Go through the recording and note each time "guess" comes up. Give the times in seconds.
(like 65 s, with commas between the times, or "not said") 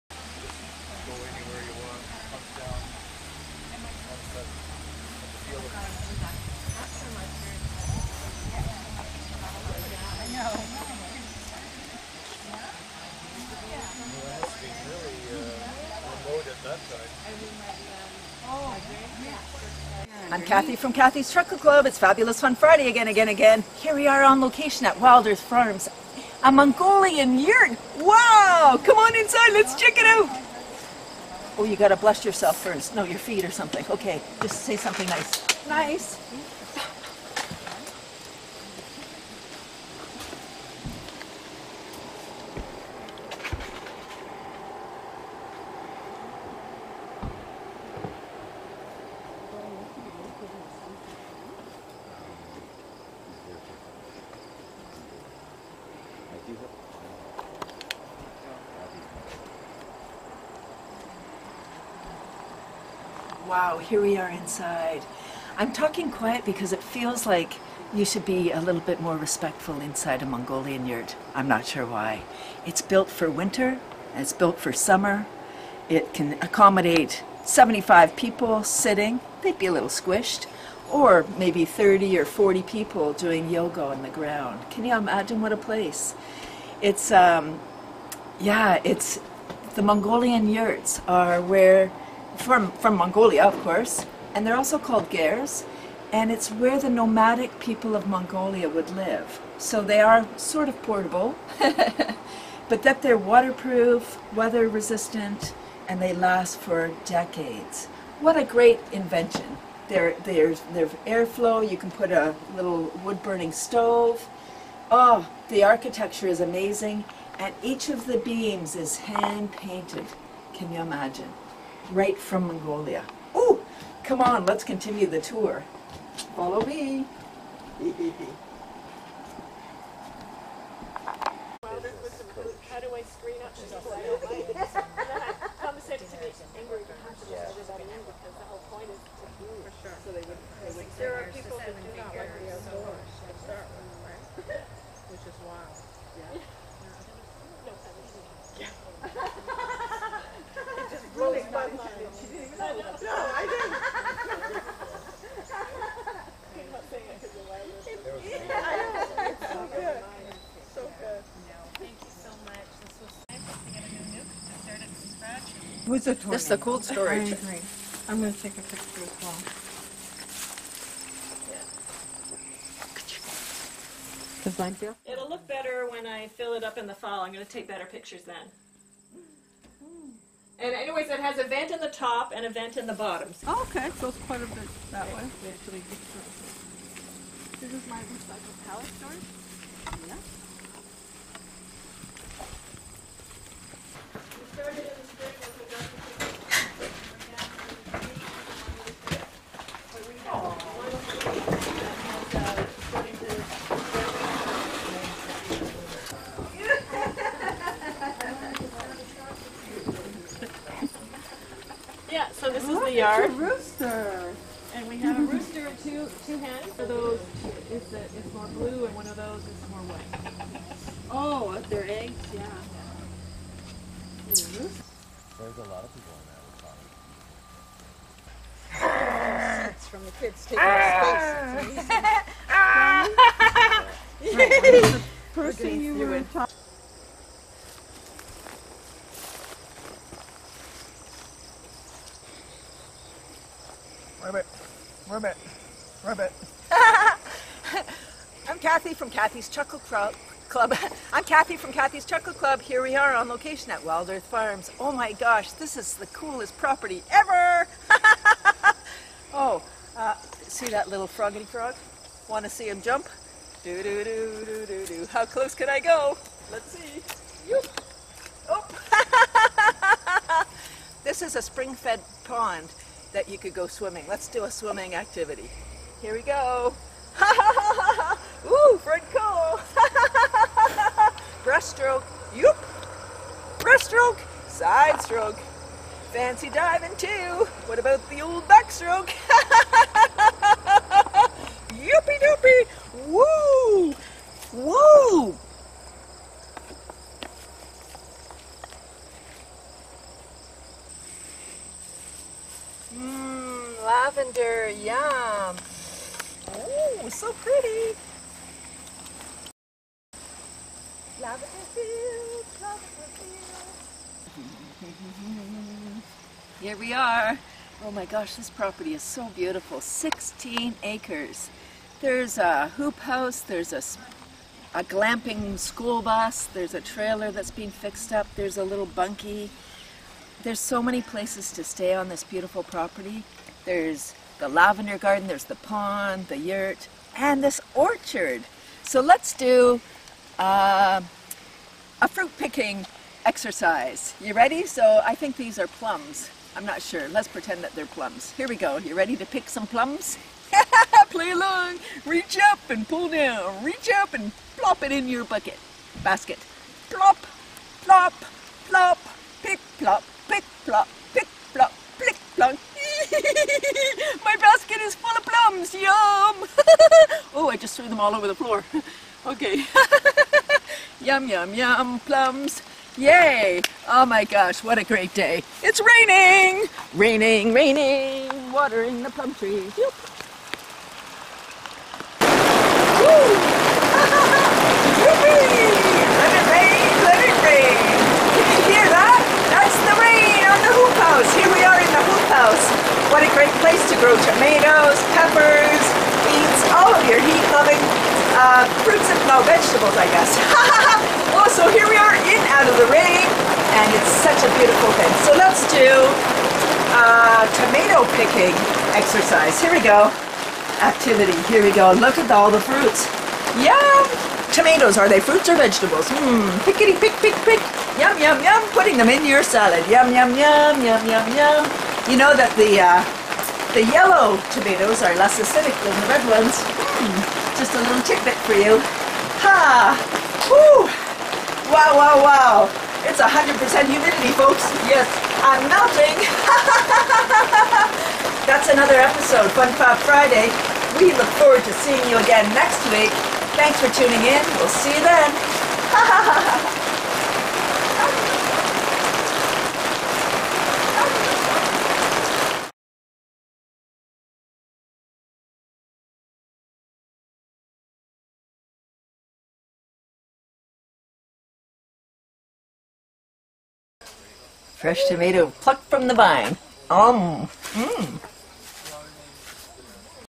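400 s.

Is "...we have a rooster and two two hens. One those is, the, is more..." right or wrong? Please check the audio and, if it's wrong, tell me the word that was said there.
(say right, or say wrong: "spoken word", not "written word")
right.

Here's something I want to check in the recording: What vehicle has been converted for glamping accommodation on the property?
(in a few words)
School bus.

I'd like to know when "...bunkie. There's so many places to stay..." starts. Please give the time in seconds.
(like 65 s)
328 s.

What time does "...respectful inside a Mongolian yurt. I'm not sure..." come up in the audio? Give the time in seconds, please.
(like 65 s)
69 s.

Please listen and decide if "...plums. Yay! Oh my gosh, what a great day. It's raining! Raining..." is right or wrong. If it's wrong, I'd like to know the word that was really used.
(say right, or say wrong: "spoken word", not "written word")
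right.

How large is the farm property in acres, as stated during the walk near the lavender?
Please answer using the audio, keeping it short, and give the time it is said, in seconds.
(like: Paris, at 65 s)
16 acres, at 319 s.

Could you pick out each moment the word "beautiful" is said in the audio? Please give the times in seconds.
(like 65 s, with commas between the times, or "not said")
319 s, 332 s, 404 s.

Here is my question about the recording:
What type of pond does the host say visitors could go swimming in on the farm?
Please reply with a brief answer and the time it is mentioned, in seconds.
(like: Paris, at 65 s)
Spring-fed, at 271 s.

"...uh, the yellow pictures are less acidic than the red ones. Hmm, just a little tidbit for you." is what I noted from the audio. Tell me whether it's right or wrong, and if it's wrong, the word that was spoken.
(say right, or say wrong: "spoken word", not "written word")
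wrong: "tomatoes", not "pictures".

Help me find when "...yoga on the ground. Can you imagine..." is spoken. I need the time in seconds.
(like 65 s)
83 s.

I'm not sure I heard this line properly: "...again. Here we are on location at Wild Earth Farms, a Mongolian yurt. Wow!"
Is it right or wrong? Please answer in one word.
right.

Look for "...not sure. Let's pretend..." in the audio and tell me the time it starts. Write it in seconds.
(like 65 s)
346 s.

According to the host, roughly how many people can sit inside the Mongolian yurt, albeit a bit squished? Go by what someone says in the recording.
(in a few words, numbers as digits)
75.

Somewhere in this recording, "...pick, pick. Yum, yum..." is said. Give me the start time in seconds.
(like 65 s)
417 s.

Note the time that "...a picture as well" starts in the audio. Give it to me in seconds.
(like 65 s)
168 s.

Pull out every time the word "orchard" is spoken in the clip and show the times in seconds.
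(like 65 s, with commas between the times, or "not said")
337 s.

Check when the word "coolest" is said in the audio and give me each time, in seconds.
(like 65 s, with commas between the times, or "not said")
256 s.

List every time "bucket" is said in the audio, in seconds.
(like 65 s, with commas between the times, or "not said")
355 s.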